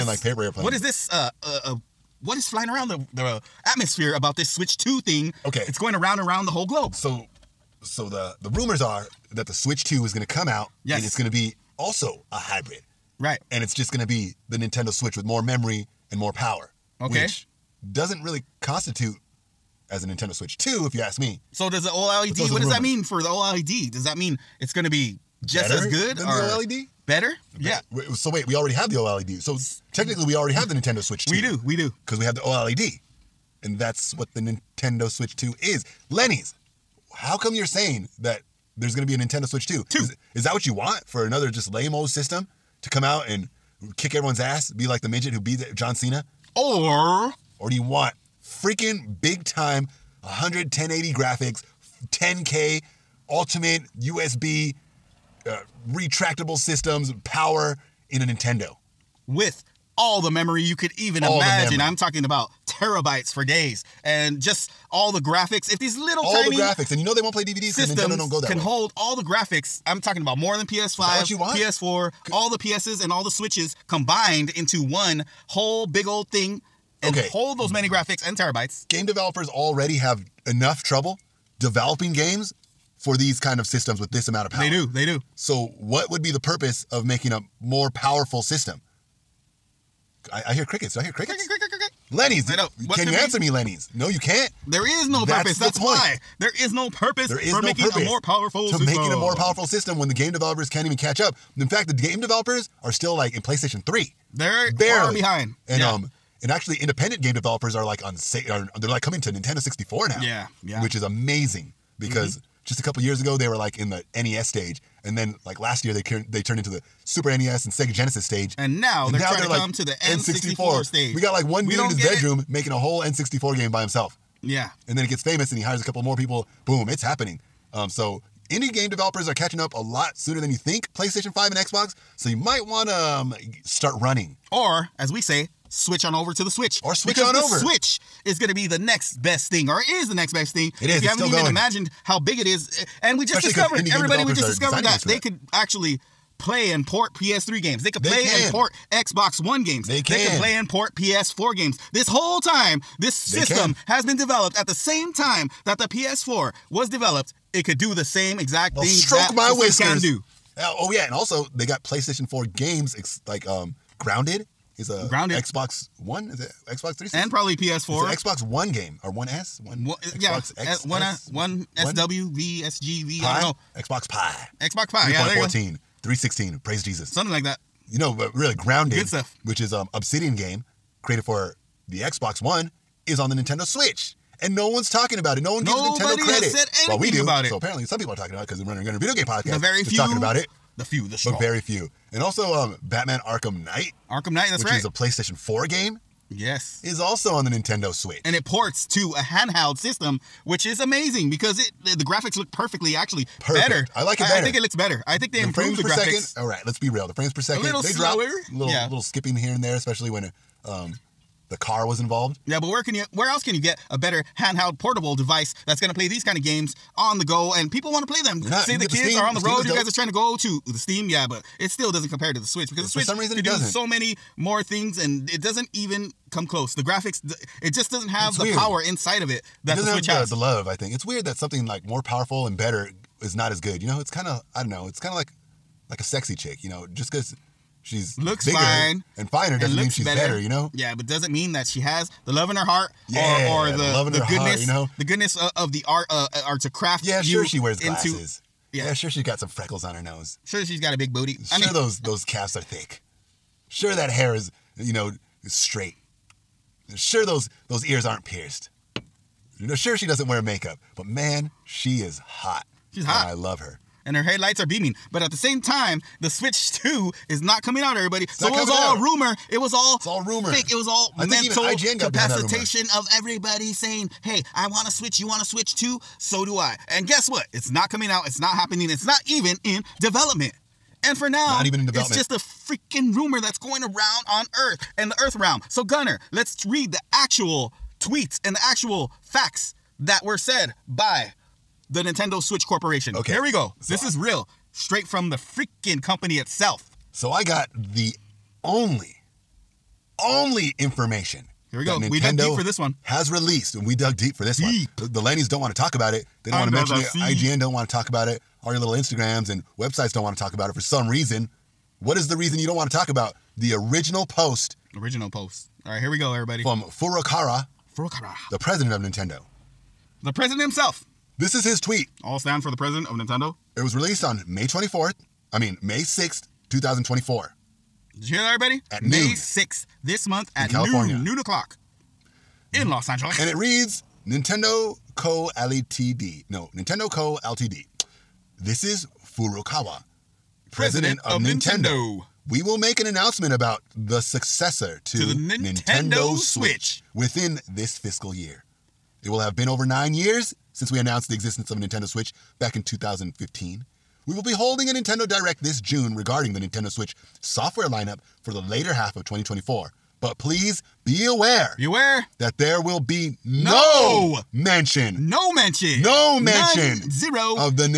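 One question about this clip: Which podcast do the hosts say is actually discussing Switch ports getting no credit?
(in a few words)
Runner and Gunner.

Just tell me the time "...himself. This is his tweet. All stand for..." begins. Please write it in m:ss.
5:20.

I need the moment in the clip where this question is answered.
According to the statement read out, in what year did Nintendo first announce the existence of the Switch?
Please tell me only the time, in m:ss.
5:52.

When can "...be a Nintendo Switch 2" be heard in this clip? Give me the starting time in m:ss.
0:39.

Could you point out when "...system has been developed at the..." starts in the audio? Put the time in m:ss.
2:33.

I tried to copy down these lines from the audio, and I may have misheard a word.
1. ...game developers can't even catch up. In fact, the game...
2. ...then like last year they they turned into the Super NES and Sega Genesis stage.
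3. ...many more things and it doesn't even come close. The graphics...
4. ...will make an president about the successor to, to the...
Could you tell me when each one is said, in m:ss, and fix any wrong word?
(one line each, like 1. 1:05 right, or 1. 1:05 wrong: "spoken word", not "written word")
1. 1:40 right
2. 1:55 right
3. 3:43 right
4. 5:42 wrong: "announcement", not "president".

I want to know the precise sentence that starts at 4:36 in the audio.
So do I." And guess what?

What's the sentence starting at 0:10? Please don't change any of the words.
and it's going to be also a hybrid, right?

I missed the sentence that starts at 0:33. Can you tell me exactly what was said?
And that's what the Nintendo Switch 2 is.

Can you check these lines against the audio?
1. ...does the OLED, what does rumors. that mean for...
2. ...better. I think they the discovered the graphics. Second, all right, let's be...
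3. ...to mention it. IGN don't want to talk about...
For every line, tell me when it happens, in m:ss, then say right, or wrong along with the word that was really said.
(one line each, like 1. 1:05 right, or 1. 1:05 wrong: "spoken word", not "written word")
1. 0:21 right
2. 3:24 wrong: "improved", not "discovered"
3. 5:06 right.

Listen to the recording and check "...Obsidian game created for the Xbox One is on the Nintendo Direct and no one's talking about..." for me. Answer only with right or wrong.
wrong.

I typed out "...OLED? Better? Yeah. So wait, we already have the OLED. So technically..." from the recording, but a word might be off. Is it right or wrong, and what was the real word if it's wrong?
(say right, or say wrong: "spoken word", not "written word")
right.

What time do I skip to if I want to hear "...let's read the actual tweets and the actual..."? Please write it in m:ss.
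4:46.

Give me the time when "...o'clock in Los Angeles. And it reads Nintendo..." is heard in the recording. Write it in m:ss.
5:31.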